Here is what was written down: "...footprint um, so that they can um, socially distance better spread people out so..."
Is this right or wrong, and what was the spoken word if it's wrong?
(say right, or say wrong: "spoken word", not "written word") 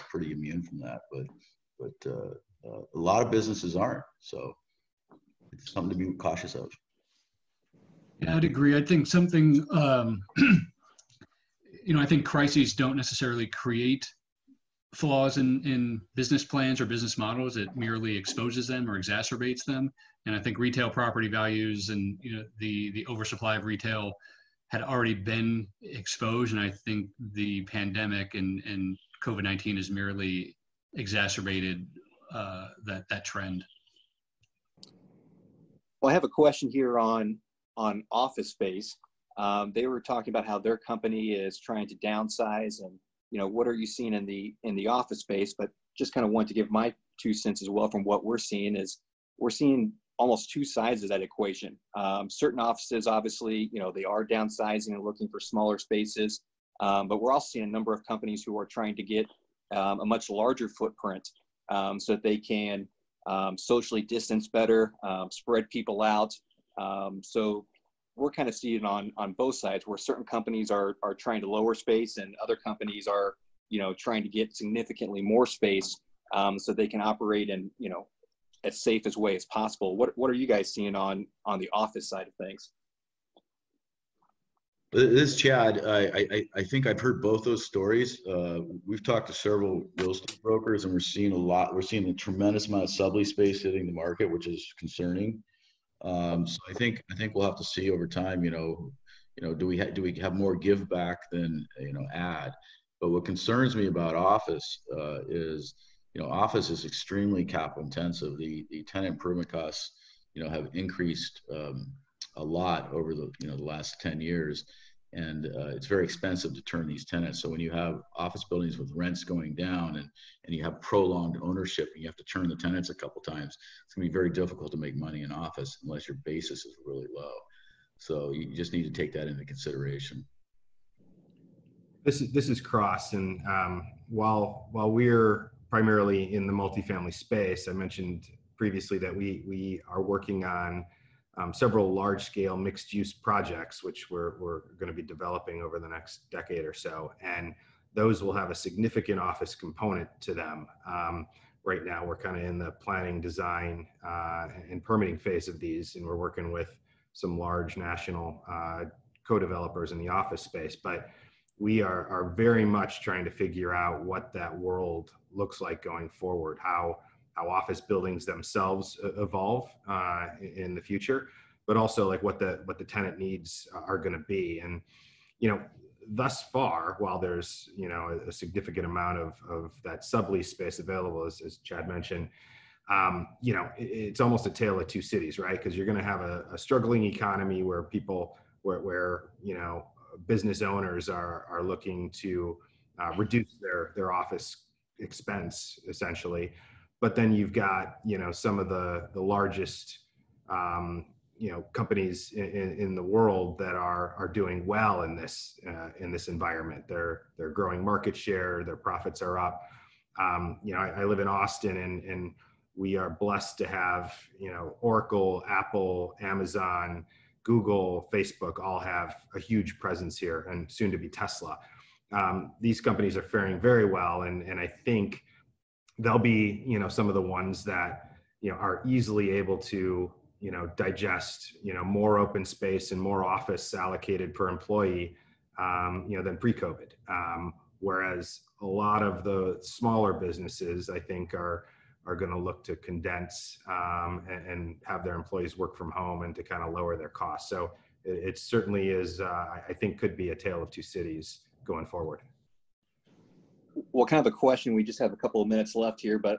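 right.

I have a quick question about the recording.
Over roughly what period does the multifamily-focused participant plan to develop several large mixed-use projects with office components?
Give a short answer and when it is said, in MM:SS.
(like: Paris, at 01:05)
next decade, at 02:25.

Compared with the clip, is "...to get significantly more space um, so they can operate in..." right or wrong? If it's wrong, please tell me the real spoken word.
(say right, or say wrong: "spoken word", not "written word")
right.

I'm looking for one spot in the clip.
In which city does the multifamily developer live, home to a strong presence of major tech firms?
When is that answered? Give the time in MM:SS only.
03:31.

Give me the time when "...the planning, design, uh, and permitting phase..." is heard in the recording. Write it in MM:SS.
02:32.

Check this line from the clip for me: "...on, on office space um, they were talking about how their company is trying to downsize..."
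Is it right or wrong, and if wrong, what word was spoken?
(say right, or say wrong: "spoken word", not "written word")
right.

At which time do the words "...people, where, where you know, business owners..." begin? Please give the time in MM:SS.
03:07.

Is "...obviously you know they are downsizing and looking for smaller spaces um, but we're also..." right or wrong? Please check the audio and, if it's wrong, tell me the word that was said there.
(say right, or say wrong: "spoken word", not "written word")
right.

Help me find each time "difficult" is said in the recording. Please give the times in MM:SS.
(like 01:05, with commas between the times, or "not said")
02:04.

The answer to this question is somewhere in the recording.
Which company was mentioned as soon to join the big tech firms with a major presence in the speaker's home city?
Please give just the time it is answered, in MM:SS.
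03:41.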